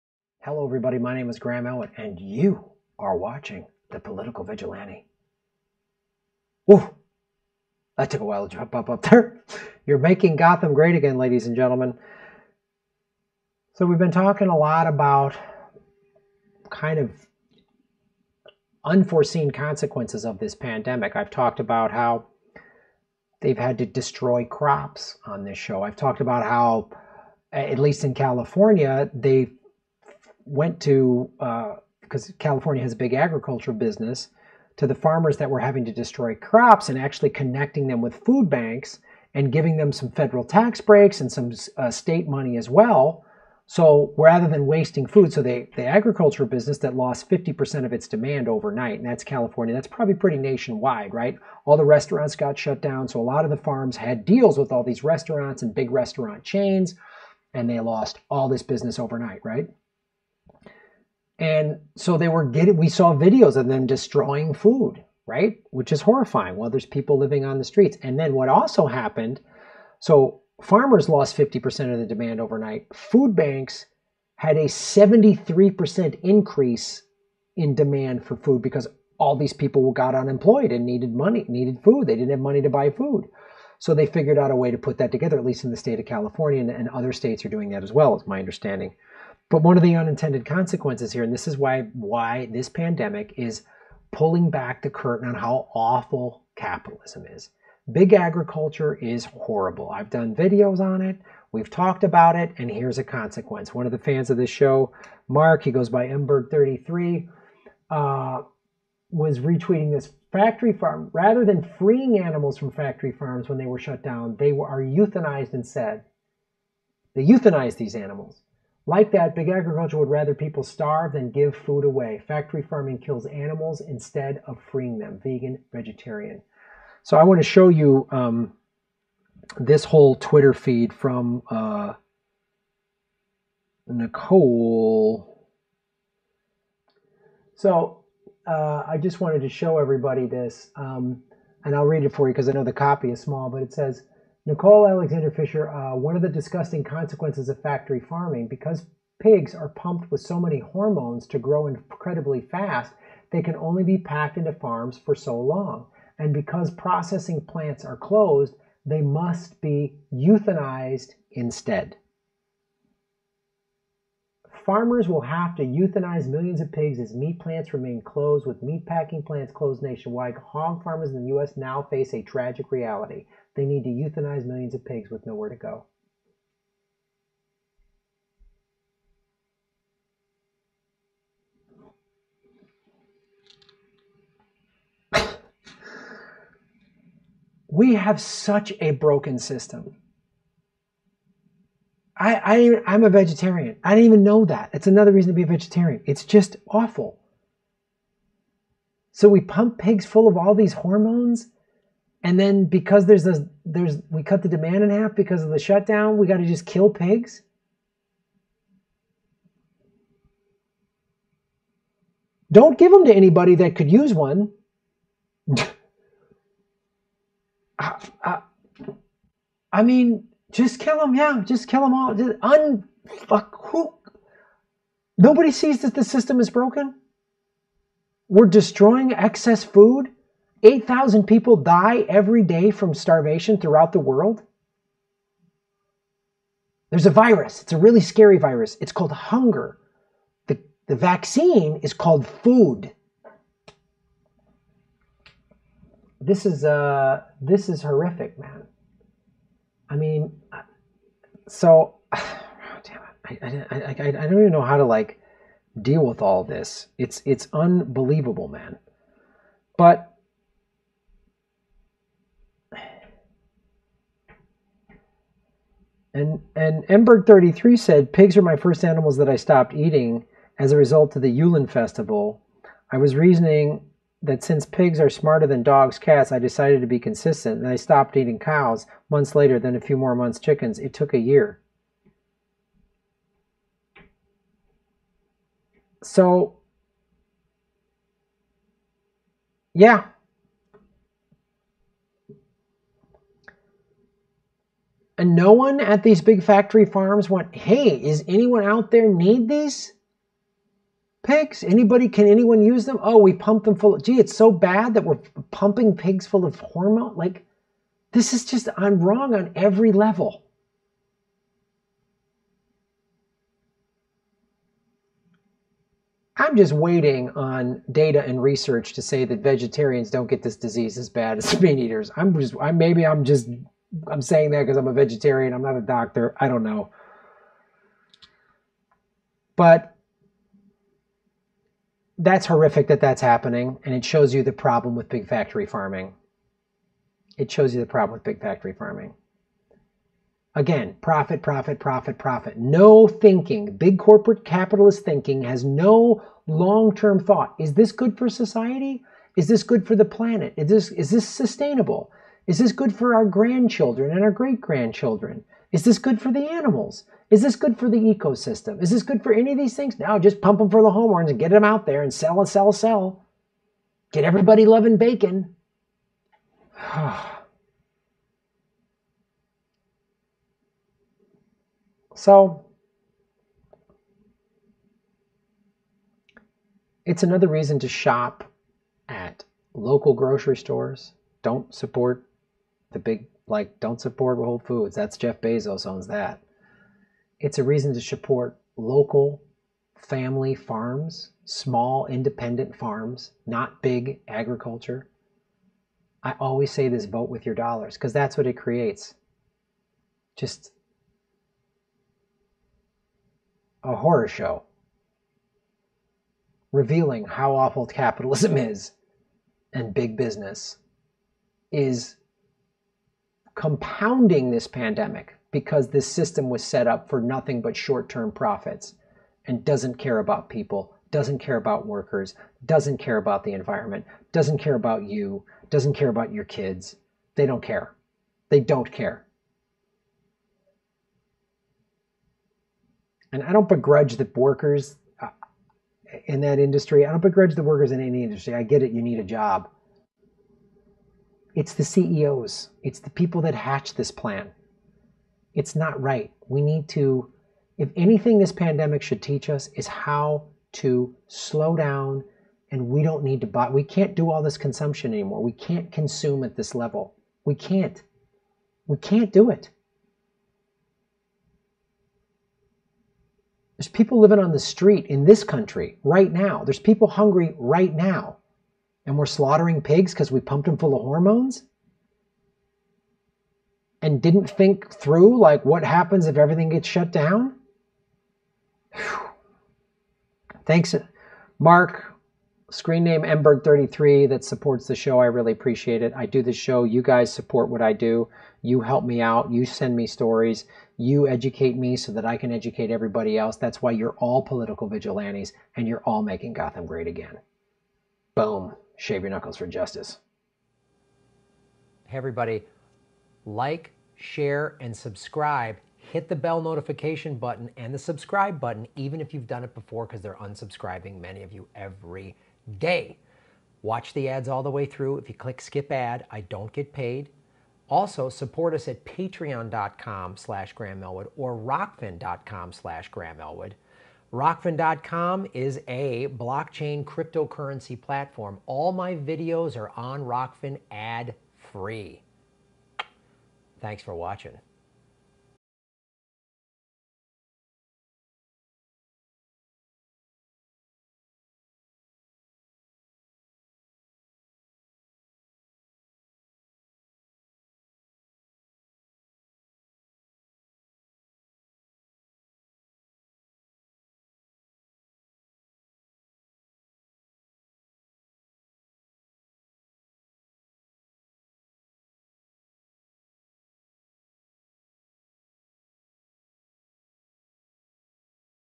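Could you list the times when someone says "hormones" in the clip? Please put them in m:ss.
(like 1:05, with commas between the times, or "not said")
2:30, 3:20, 5:06, 6:00, 7:51.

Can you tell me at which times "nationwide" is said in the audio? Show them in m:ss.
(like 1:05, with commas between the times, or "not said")
0:50, 2:49.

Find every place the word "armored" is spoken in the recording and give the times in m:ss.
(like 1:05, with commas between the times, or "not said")
not said.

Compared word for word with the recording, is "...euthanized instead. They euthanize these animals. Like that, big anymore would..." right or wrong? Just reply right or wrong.
wrong.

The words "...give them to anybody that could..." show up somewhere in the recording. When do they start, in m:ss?
3:32.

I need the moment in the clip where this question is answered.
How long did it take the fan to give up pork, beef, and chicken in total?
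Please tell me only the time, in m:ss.
4:41.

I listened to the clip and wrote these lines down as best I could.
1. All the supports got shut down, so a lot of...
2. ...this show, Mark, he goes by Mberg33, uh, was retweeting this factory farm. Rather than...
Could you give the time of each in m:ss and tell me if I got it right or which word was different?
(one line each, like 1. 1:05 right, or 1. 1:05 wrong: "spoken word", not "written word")
1. 0:51 wrong: "restaurants", not "supports"
2. 1:44 right.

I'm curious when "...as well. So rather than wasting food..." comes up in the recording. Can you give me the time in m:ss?
0:42.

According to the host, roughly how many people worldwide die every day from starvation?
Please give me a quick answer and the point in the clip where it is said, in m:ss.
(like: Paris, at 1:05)
8,000, at 3:50.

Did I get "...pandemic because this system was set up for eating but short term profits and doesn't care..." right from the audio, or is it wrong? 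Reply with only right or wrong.
wrong.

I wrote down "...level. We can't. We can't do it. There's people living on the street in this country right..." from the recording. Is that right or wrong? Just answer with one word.
right.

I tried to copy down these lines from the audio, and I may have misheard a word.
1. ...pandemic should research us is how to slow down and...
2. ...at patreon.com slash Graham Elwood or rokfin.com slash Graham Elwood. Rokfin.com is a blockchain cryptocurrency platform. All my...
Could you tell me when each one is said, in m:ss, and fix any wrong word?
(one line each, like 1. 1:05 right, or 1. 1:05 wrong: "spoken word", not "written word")
1. 7:28 wrong: "teach", not "research"
2. 8:38 right.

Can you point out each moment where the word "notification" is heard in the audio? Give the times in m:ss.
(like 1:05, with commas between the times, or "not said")
8:26.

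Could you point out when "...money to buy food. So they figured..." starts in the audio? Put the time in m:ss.
1:22.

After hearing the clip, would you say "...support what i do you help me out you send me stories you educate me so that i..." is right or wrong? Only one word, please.
right.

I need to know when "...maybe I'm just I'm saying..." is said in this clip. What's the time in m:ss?
5:22.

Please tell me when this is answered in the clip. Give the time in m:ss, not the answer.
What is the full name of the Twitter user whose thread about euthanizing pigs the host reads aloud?
2:24.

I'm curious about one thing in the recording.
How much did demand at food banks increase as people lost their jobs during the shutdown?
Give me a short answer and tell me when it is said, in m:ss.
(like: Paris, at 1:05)
73%, at 1:14.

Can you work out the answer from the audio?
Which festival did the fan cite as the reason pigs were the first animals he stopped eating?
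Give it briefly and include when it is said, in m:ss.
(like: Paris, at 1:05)
Yulin festival, at 4:31.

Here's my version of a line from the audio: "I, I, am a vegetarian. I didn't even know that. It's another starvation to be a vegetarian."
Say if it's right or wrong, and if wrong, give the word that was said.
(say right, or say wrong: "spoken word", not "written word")
wrong: "reason", not "starvation".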